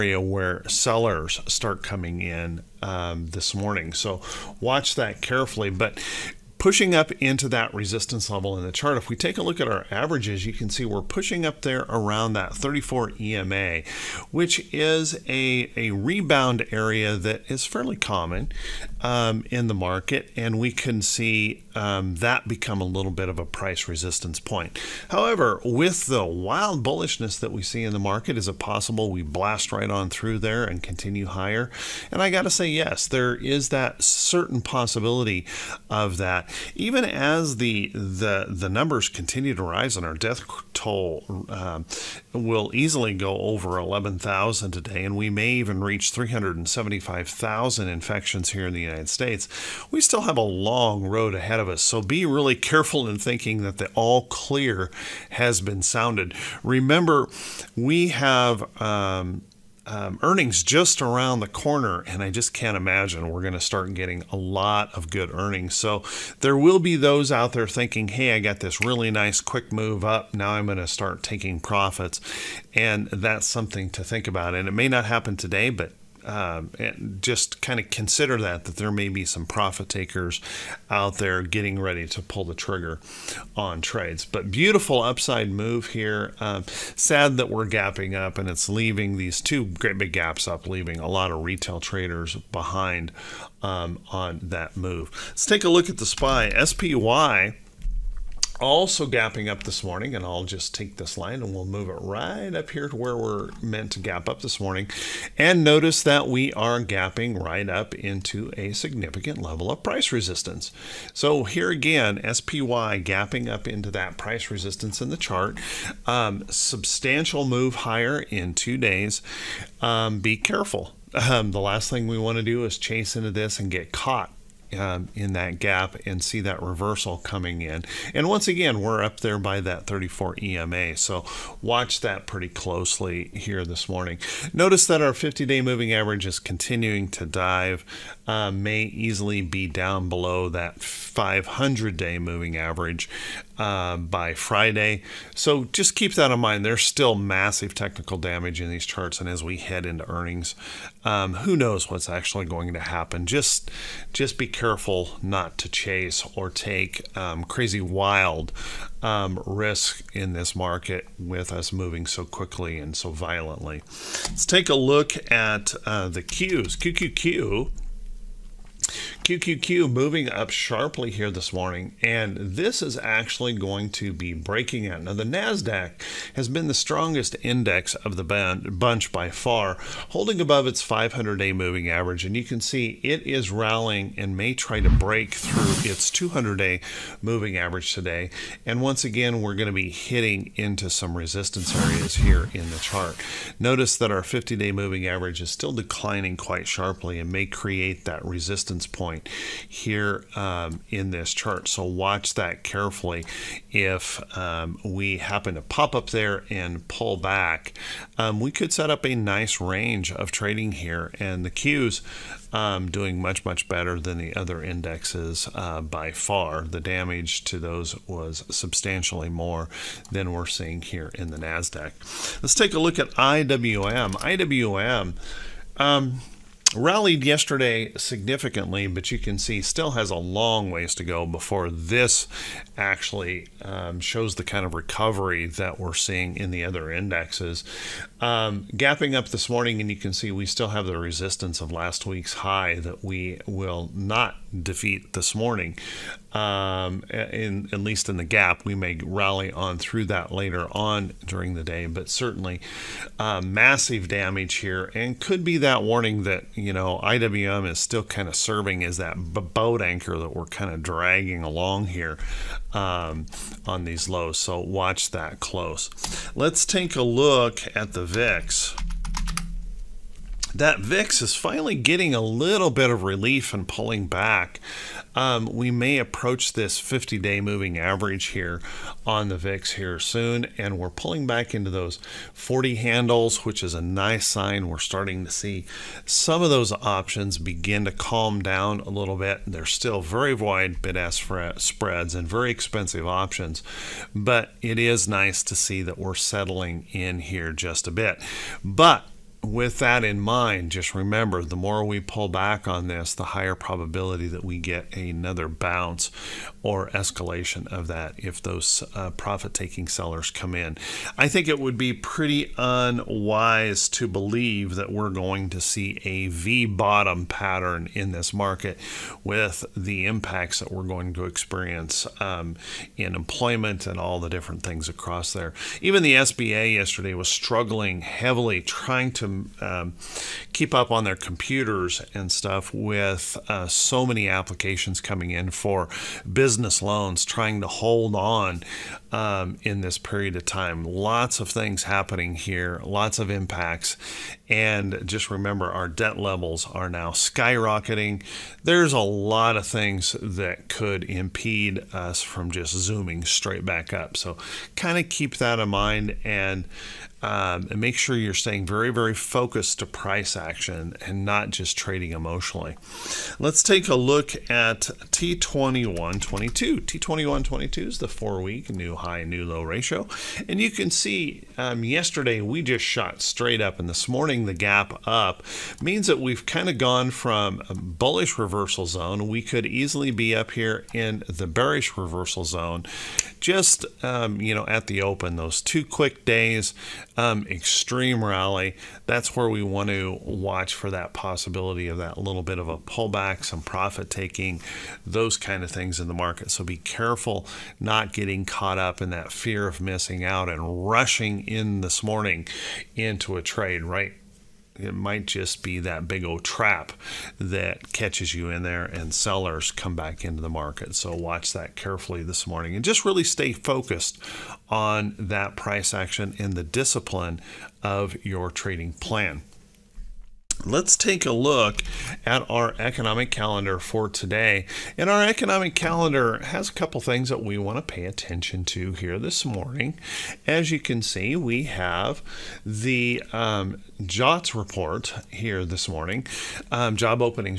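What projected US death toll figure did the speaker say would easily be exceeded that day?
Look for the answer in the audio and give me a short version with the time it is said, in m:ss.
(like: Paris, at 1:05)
11,000, at 0:43.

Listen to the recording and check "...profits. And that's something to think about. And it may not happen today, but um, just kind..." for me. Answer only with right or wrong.
right.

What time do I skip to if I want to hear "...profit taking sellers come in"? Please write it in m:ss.
5:09.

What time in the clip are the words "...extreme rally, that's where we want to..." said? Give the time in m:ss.
6:27.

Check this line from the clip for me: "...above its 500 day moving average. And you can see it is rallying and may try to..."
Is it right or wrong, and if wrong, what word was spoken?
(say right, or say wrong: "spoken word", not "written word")
right.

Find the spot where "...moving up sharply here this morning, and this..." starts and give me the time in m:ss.
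2:49.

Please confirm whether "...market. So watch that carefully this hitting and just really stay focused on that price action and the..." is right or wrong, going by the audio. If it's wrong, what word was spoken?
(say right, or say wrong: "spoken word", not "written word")
wrong: "morning", not "hitting".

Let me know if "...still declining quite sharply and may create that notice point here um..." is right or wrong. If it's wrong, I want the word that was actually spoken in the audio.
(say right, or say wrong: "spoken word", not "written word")
wrong: "resistance", not "notice".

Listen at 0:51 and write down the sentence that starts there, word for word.
So be really careful in thinking that the all clear has been sounded.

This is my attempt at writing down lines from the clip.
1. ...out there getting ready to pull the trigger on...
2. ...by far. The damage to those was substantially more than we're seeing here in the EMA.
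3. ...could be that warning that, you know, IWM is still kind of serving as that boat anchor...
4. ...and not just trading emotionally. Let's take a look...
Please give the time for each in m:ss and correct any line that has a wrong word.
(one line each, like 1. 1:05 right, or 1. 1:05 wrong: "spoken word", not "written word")
1. 1:20 right
2. 3:35 wrong: "NASDAQ", not "EMA"
3. 4:15 right
4. 6:01 right.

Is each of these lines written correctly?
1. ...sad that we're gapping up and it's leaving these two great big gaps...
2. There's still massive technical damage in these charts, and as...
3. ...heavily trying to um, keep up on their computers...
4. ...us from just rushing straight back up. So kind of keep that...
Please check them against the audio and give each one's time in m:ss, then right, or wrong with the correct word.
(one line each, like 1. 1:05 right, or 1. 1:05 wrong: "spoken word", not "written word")
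1. 1:26 right
2. 2:26 right
3. 5:28 right
4. 5:51 wrong: "zooming", not "rushing".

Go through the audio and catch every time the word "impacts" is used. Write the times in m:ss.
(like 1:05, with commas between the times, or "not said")
5:20, 5:43.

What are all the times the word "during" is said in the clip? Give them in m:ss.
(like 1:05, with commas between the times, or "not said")
4:11.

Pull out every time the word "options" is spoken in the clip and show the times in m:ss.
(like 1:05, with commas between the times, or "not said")
4:46, 4:53.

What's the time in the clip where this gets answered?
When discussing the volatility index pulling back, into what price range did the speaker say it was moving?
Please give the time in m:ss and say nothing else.
4:42.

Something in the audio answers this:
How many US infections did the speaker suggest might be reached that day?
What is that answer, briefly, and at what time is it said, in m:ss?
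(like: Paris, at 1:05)
375,000, at 0:46.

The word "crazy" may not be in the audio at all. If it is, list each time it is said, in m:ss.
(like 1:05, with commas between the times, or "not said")
2:37.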